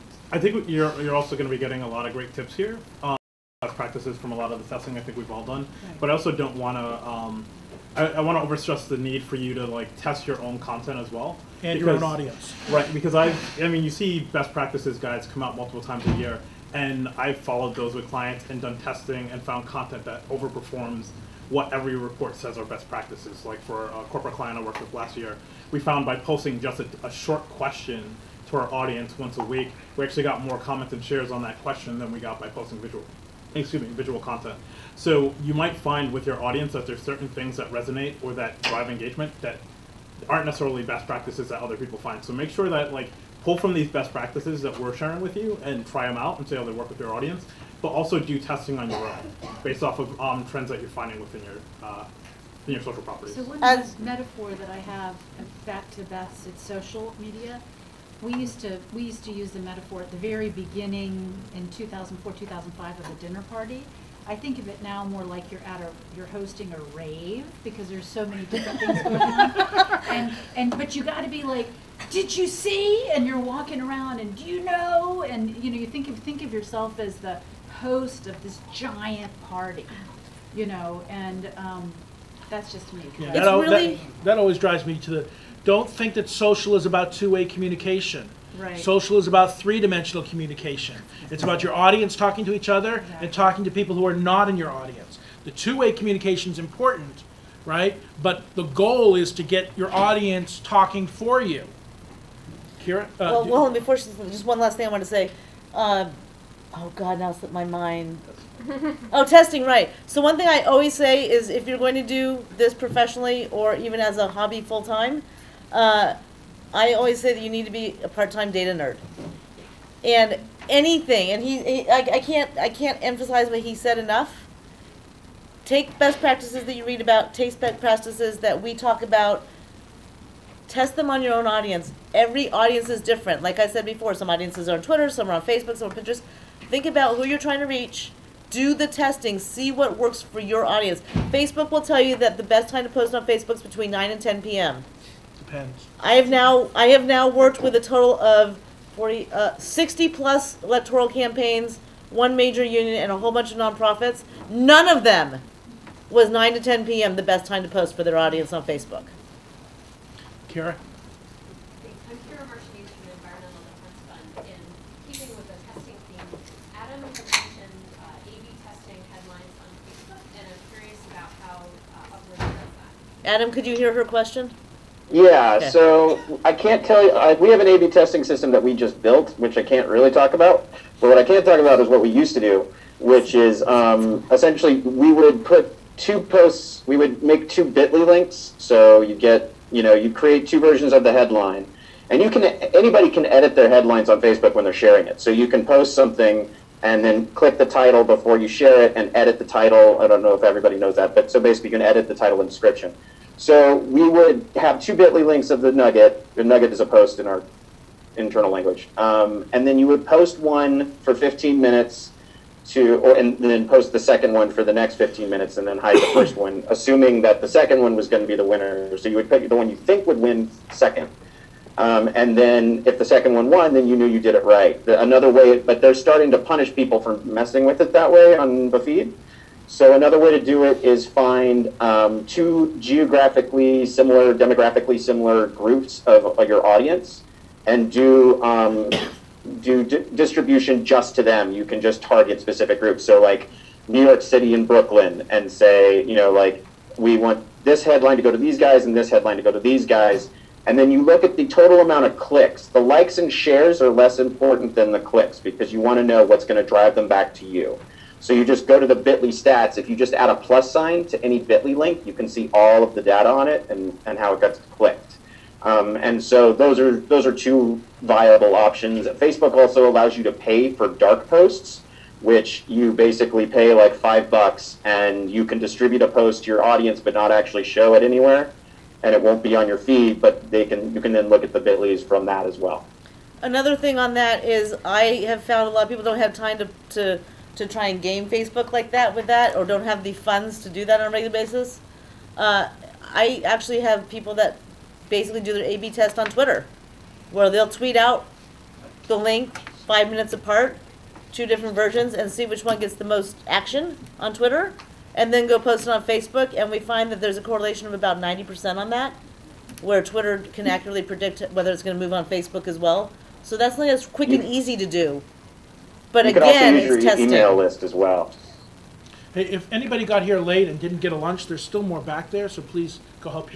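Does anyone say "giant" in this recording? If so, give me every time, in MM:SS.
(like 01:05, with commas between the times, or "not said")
01:18.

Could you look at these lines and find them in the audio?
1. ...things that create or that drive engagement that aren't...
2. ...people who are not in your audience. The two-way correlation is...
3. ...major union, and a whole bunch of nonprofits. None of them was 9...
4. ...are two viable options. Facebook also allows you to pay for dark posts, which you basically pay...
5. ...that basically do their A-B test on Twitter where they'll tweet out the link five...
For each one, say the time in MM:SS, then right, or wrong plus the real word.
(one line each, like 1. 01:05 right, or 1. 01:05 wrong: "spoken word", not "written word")
1. 00:37 wrong: "resonate", not "create"
2. 01:33 wrong: "communication", not "correlation"
3. 02:32 right
4. 04:27 right
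5. 04:54 right.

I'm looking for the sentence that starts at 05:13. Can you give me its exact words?
So that's something that's quick and easy to do.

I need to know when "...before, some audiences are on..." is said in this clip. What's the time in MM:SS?
02:13.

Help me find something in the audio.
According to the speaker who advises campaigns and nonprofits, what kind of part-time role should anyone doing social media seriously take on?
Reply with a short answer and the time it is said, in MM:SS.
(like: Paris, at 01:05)
data nerd, at 01:58.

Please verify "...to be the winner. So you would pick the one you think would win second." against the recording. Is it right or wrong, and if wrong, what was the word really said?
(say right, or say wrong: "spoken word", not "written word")
right.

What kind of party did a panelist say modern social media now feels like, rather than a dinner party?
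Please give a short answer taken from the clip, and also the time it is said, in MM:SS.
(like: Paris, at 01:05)
a rave, at 01:06.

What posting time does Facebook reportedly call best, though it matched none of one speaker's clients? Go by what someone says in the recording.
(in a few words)
9 to 10 p.m.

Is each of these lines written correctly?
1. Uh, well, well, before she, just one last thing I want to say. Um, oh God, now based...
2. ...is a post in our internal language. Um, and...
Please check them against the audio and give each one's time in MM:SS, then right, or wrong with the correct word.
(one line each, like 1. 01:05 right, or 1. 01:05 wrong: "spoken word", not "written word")
1. 01:43 wrong: "slipped", not "based"
2. 03:26 right.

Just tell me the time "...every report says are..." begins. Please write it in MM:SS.
00:21.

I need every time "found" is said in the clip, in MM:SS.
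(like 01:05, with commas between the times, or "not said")
00:19, 00:25, 04:45.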